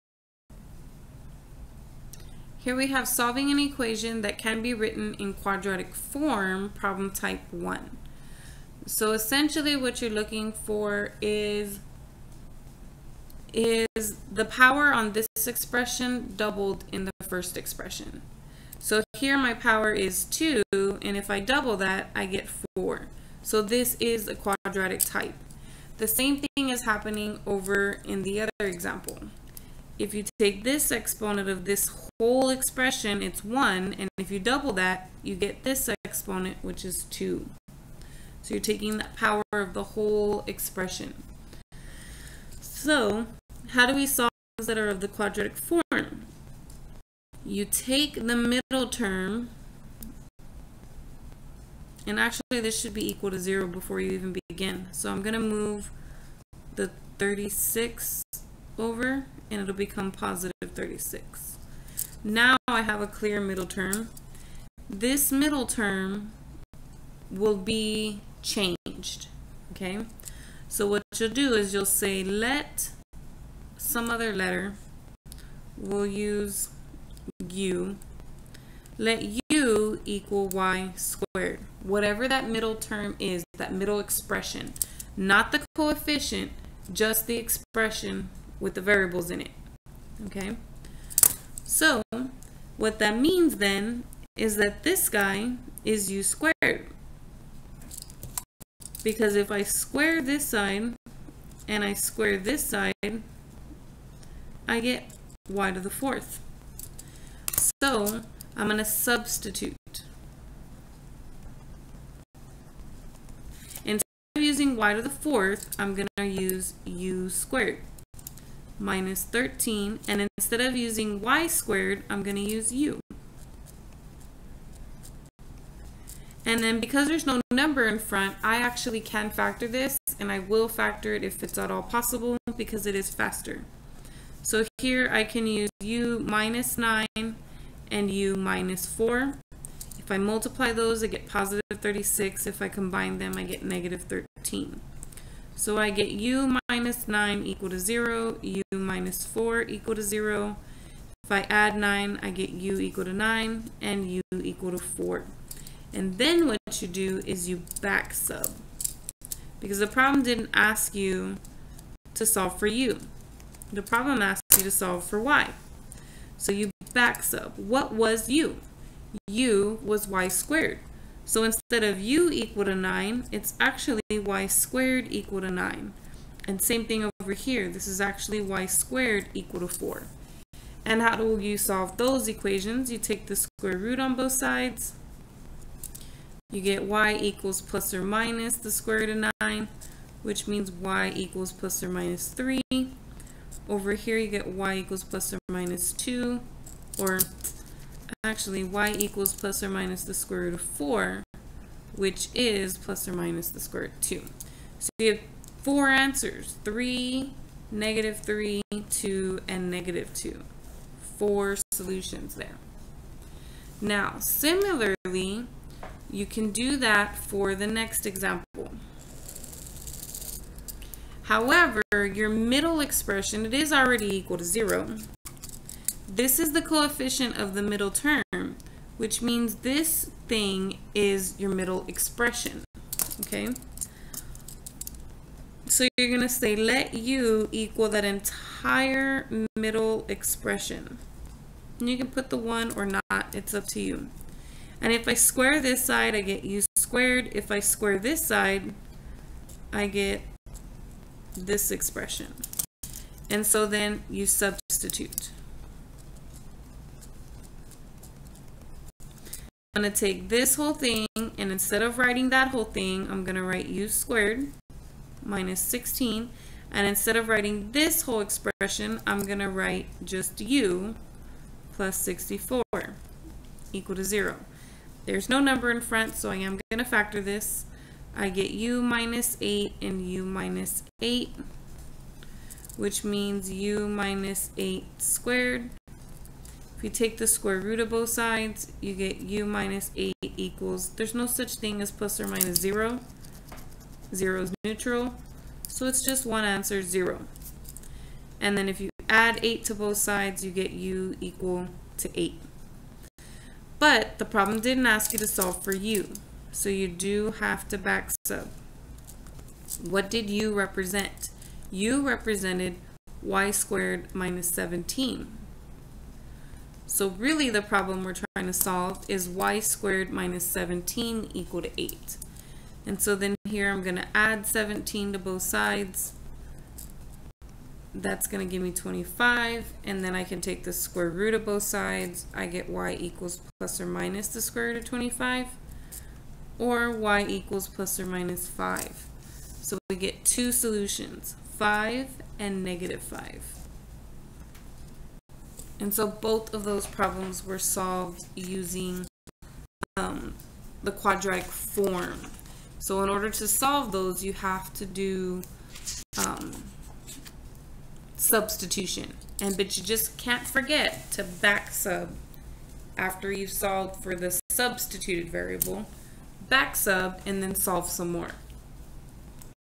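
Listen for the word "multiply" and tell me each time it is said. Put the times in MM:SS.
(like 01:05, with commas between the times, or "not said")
02:20.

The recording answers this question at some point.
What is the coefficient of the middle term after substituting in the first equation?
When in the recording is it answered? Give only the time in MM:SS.
01:56.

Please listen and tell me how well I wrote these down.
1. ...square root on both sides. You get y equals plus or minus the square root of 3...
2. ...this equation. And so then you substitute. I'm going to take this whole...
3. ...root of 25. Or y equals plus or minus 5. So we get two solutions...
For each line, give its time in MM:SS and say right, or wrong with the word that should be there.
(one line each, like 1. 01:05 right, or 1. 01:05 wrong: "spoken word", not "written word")
1. 03:03 wrong: "9", not "3"
2. 04:11 wrong: "expression", not "equation"
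3. 05:34 right.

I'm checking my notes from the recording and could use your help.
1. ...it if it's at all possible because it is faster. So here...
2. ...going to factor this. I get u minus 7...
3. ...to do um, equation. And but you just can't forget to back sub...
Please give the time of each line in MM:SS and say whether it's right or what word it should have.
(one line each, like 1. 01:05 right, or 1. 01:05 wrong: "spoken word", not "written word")
1. 02:11 right
2. 04:36 wrong: "8", not "7"
3. 05:54 wrong: "substitution", not "equation".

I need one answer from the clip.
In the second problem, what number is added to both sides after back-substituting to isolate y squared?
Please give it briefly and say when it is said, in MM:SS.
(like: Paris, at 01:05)
17, at 05:24.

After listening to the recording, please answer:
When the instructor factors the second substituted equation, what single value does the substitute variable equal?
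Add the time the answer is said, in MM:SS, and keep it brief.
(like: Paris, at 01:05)
8, at 05:00.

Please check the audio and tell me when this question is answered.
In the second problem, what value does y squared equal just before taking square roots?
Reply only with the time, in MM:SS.
05:27.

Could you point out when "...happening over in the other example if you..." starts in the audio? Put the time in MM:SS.
00:26.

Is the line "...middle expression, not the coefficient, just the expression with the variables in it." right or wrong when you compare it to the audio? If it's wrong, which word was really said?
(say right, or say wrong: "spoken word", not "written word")
right.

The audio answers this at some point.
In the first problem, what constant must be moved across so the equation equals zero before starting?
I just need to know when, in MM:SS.
00:59.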